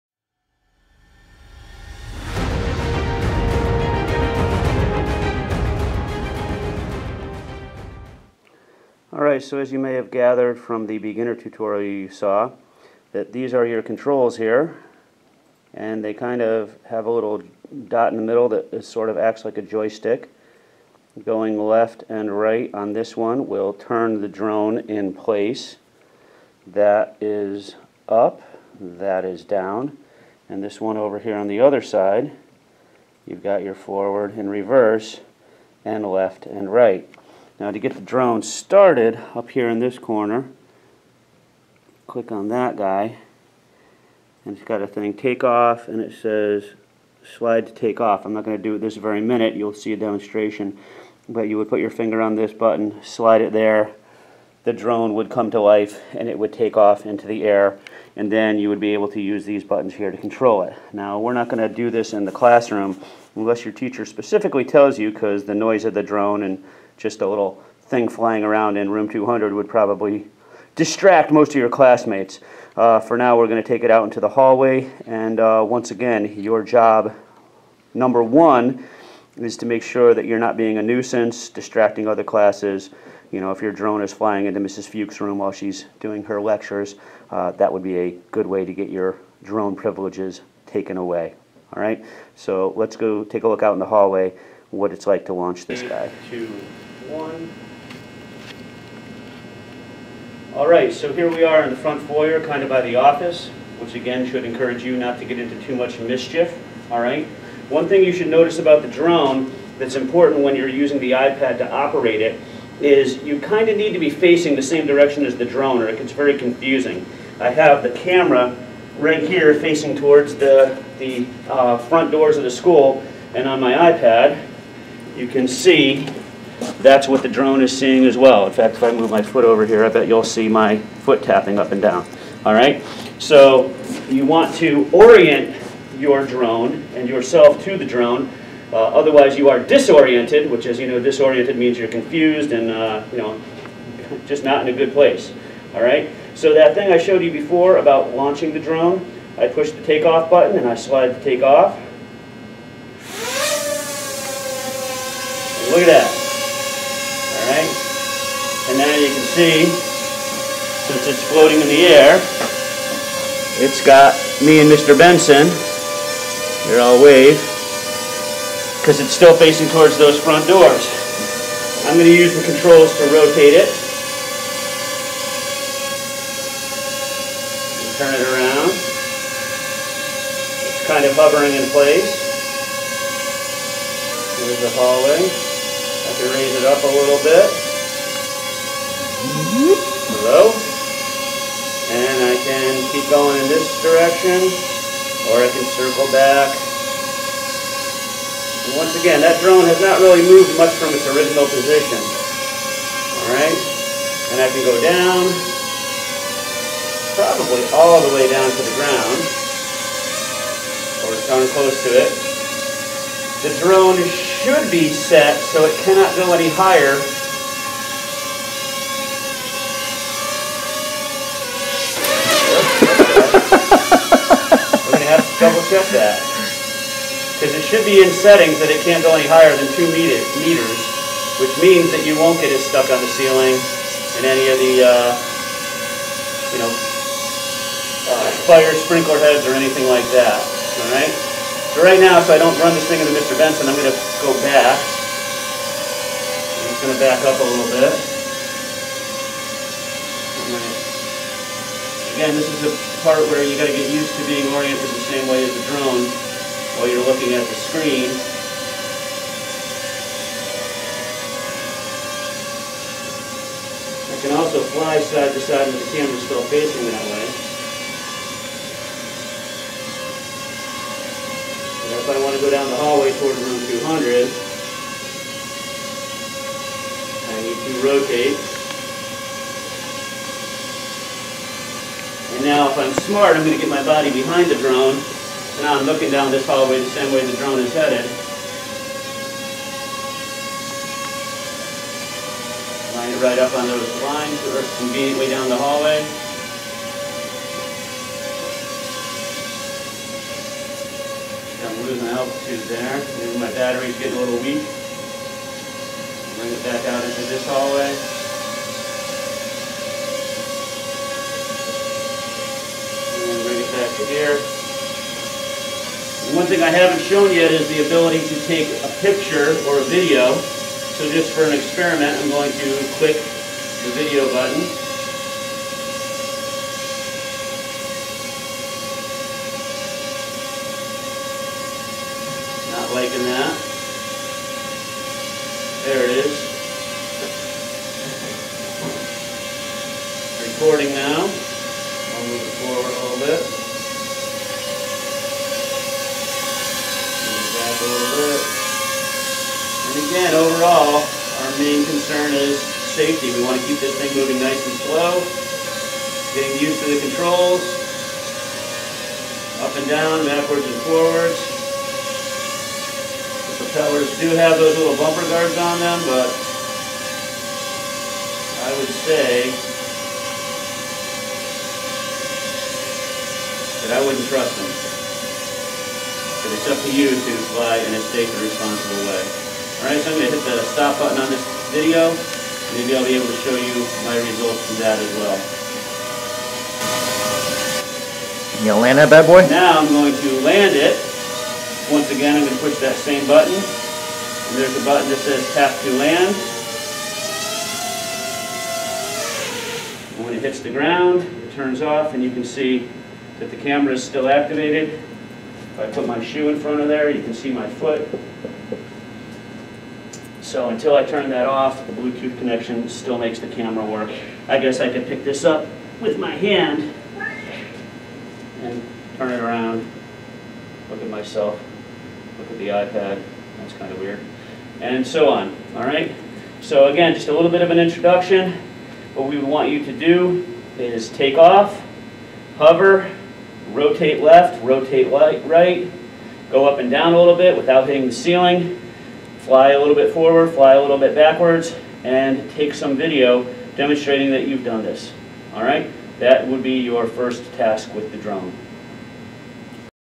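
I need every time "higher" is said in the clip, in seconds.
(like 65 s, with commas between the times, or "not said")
216 s, 229 s.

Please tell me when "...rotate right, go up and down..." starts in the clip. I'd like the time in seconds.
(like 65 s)
434 s.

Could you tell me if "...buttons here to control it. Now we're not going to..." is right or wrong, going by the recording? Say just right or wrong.
right.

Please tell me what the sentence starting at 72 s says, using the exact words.
Uh, for now, we're going to take it out into the hallway.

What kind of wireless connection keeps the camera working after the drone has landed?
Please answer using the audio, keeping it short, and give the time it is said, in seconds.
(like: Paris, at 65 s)
Bluetooth, at 411 s.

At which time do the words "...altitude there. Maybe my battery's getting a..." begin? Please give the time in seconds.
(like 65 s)
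302 s.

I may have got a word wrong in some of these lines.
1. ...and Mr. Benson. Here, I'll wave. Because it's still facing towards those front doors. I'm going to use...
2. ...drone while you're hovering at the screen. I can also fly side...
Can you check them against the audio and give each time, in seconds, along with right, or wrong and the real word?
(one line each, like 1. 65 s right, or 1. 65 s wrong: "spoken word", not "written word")
1. 164 s right
2. 255 s wrong: "looking", not "hovering".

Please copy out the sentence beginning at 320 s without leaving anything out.
So just for an experiment, I'm going to click the video button.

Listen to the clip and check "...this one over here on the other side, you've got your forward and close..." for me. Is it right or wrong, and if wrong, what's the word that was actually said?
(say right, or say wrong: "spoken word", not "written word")
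wrong: "reverse", not "close".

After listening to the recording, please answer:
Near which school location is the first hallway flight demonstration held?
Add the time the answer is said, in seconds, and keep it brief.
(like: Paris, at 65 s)
the office, at 102 s.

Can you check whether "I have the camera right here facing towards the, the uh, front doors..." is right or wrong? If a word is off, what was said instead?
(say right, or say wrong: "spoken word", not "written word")
right.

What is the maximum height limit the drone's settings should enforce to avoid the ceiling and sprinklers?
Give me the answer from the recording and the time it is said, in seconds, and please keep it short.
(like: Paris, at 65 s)
2 meters, at 229 s.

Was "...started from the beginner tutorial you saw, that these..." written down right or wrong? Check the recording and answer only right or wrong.
wrong.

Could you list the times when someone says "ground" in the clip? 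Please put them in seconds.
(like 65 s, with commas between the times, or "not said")
208 s, 400 s.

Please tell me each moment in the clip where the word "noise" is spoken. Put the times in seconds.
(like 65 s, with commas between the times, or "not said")
65 s.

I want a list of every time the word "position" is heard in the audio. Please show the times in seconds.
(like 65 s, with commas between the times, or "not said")
201 s.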